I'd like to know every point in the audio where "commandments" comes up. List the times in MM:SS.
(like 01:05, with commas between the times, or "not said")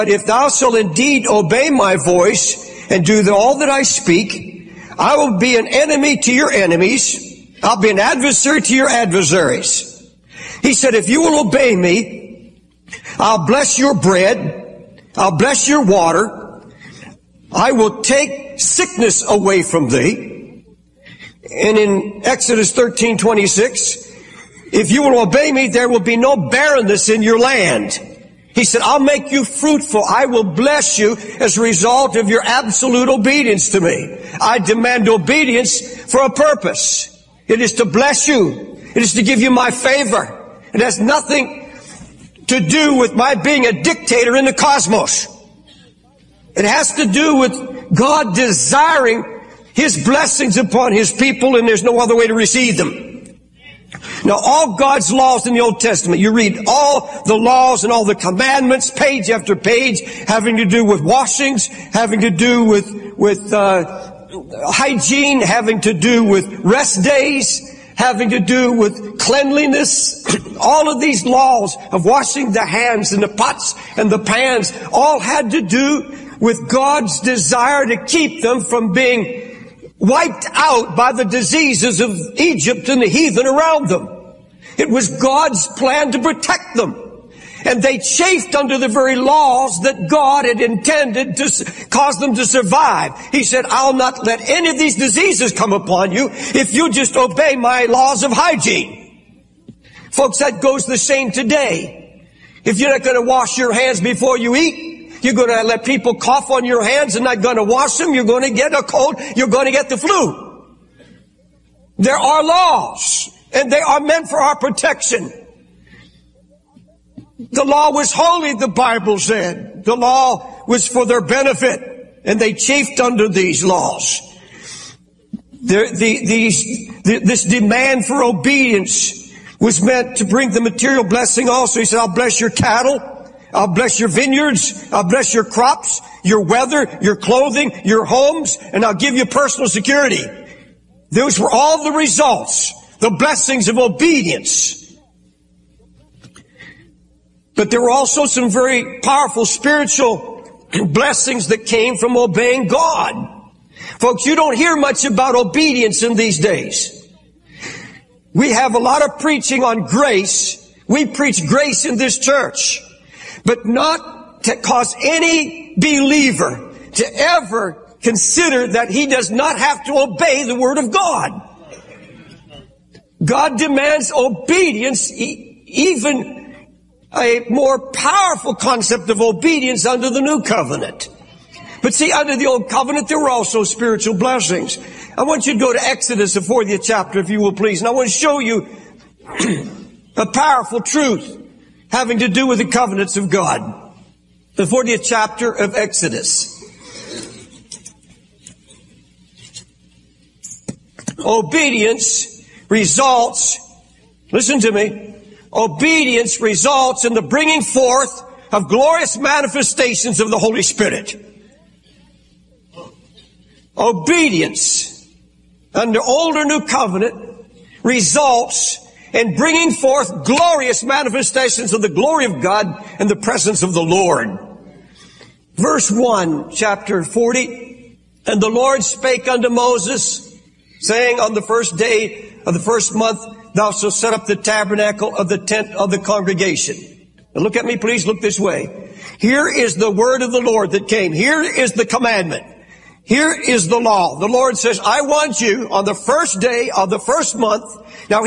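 00:58, 04:01.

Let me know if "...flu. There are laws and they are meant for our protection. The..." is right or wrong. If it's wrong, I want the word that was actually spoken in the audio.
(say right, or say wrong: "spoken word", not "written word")
right.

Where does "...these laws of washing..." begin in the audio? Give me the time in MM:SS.
01:11.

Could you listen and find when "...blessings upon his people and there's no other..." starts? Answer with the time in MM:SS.
00:50.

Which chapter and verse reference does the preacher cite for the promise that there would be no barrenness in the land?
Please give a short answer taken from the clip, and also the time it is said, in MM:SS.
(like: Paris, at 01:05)
Exodus 13:26, at 00:22.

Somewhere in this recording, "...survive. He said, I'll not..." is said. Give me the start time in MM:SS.
01:32.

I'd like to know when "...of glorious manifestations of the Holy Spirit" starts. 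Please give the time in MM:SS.
03:28.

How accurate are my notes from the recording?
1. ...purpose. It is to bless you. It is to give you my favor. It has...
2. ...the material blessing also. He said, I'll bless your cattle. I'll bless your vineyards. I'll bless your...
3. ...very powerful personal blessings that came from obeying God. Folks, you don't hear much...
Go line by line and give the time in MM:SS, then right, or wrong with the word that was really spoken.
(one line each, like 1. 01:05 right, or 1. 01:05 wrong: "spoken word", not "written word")
1. 00:36 right
2. 02:10 right
3. 02:28 wrong: "spiritual", not "personal".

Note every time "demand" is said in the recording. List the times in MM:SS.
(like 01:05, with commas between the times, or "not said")
00:34, 02:07, 02:53.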